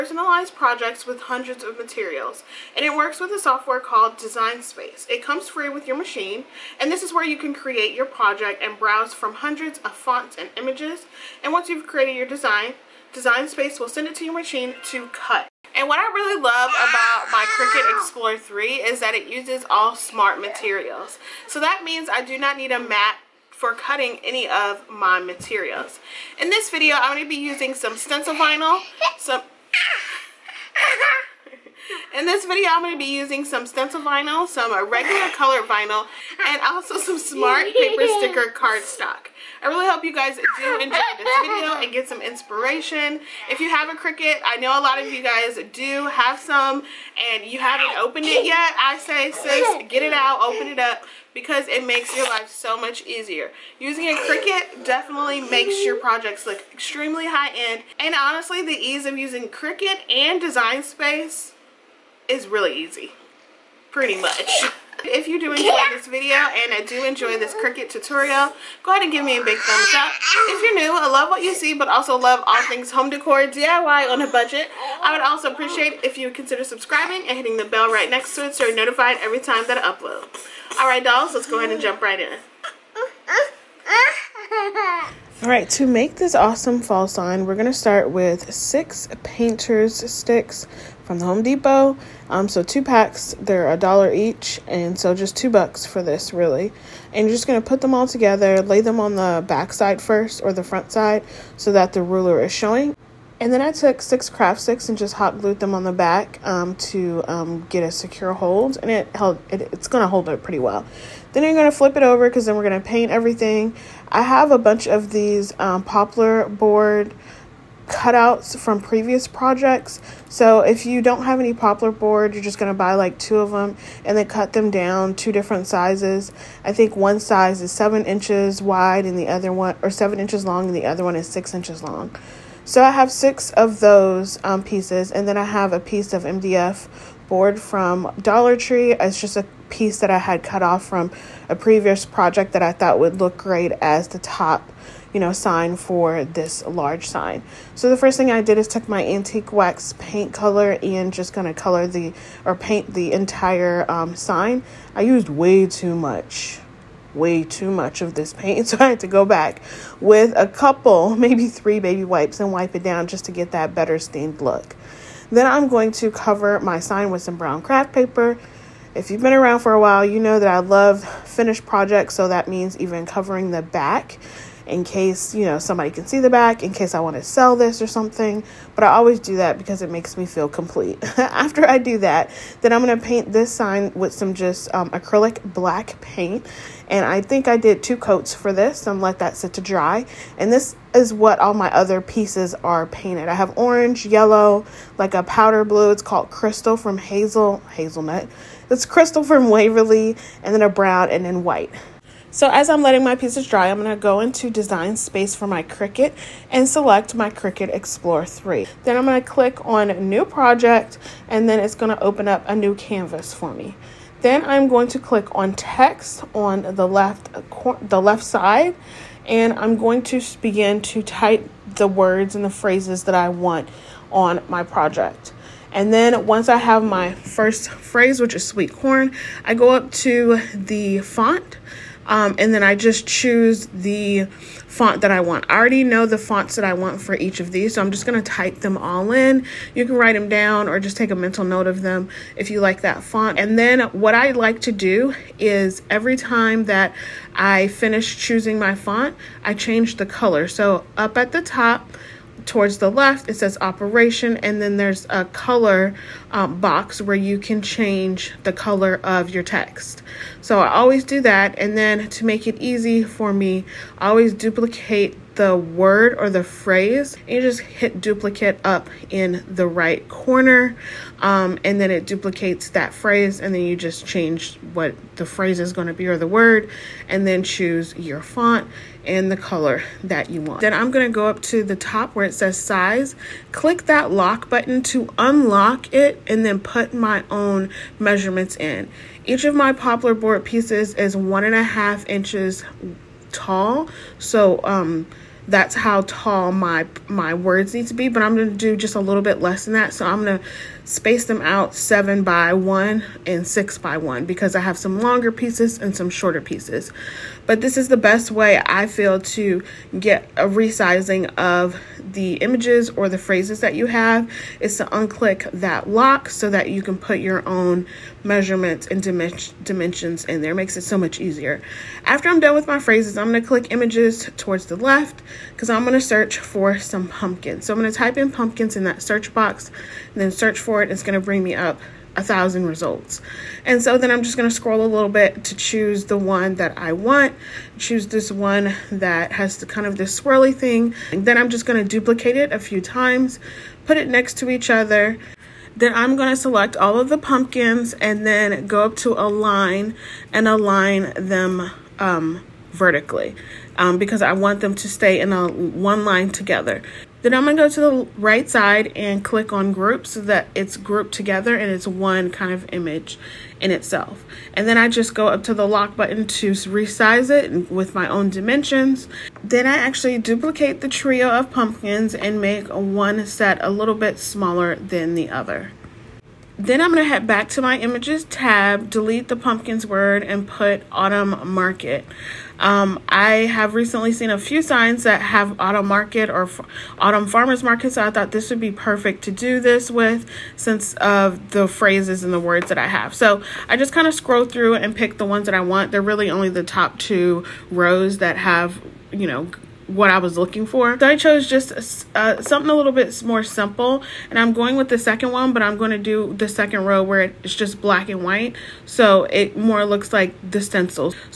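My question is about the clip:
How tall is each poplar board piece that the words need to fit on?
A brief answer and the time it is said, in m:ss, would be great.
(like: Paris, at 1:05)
1.5 inches, at 4:51.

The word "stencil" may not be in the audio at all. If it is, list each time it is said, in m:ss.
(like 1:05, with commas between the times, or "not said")
0:27, 0:33, 6:50.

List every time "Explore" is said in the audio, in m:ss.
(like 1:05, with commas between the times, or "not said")
0:17, 3:27.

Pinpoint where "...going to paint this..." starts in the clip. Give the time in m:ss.
3:02.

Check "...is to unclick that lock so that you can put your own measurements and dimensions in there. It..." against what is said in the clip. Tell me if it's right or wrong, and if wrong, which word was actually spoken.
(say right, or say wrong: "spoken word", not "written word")
right.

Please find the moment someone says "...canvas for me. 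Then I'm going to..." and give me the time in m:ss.
3:32.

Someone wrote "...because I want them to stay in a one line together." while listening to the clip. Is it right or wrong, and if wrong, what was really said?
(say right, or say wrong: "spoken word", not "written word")
right.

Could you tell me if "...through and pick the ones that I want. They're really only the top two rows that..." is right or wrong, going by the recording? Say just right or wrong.
right.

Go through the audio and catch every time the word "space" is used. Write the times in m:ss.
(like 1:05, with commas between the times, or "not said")
0:04, 0:13, 1:00, 3:24, 5:00.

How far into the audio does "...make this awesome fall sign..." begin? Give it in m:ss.
1:25.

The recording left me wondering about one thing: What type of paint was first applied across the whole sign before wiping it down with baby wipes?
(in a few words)
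antique wax paint.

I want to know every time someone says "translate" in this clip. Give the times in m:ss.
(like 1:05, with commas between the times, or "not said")
not said.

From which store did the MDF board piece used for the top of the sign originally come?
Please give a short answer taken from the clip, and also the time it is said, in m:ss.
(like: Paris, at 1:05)
Dollar Tree, at 2:18.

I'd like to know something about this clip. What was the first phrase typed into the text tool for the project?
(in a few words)
sweet corn.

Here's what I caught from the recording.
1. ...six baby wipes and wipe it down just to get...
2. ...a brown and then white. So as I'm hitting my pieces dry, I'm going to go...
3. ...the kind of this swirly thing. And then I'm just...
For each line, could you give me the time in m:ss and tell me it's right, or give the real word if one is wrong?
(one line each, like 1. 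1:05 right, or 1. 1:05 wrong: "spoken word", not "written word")
1. 2:41 wrong: "three", not "six"
2. 3:20 wrong: "letting", not "hitting"
3. 5:39 right.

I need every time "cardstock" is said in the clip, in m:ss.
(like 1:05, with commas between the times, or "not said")
0:38.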